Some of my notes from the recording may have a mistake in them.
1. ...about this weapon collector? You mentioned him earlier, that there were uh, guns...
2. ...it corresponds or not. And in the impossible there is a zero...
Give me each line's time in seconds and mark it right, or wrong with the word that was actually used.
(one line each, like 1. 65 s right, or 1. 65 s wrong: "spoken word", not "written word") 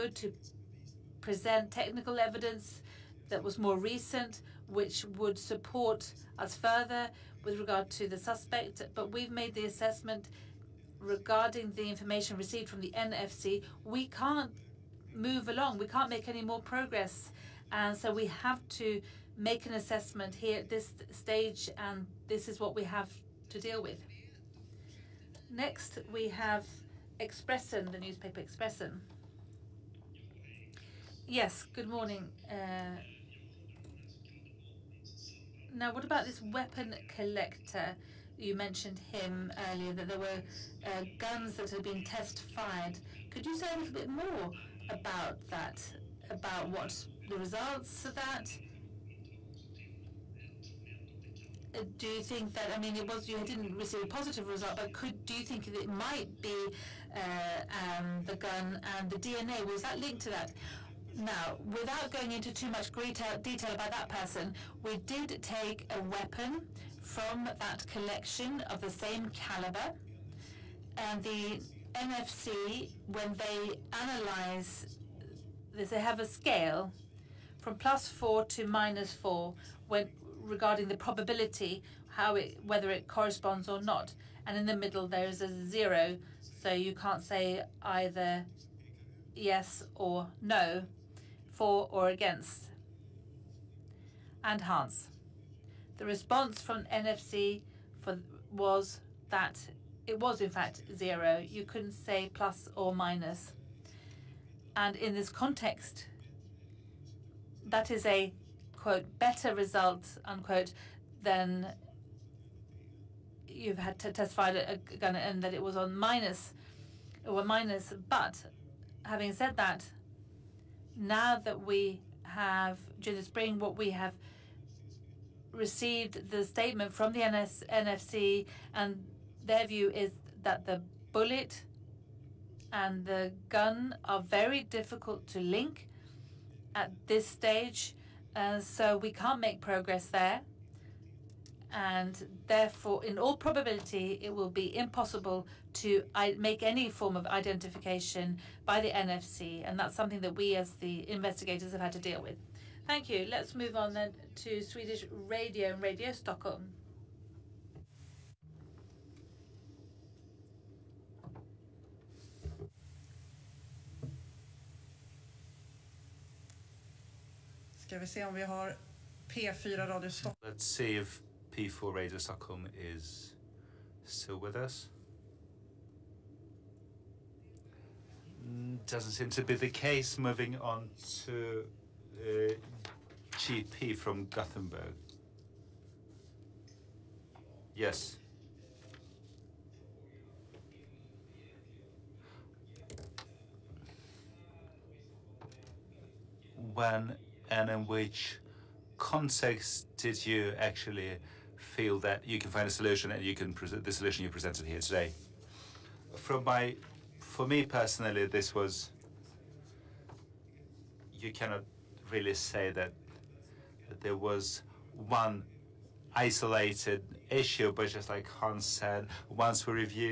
1. 36 s right
2. 82 s wrong: "middle", not "impossible".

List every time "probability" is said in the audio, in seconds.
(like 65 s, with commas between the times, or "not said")
80 s, 143 s.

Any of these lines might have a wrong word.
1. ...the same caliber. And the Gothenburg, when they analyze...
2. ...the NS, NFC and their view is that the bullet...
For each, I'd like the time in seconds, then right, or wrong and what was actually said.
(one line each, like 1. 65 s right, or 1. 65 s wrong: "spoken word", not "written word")
1. 68 s wrong: "NFC", not "Gothenburg"
2. 127 s right.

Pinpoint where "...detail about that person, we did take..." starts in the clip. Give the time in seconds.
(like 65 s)
62 s.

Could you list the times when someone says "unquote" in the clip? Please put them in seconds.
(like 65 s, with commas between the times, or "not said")
110 s.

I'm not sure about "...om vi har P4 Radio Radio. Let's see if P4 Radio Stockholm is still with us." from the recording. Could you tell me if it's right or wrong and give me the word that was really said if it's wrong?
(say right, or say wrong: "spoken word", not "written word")
wrong: "Stockholm", not "Radio".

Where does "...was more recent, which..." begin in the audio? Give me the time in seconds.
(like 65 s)
3 s.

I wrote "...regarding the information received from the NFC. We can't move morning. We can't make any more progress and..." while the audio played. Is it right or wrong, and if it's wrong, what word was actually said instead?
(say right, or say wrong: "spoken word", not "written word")
wrong: "along", not "morning".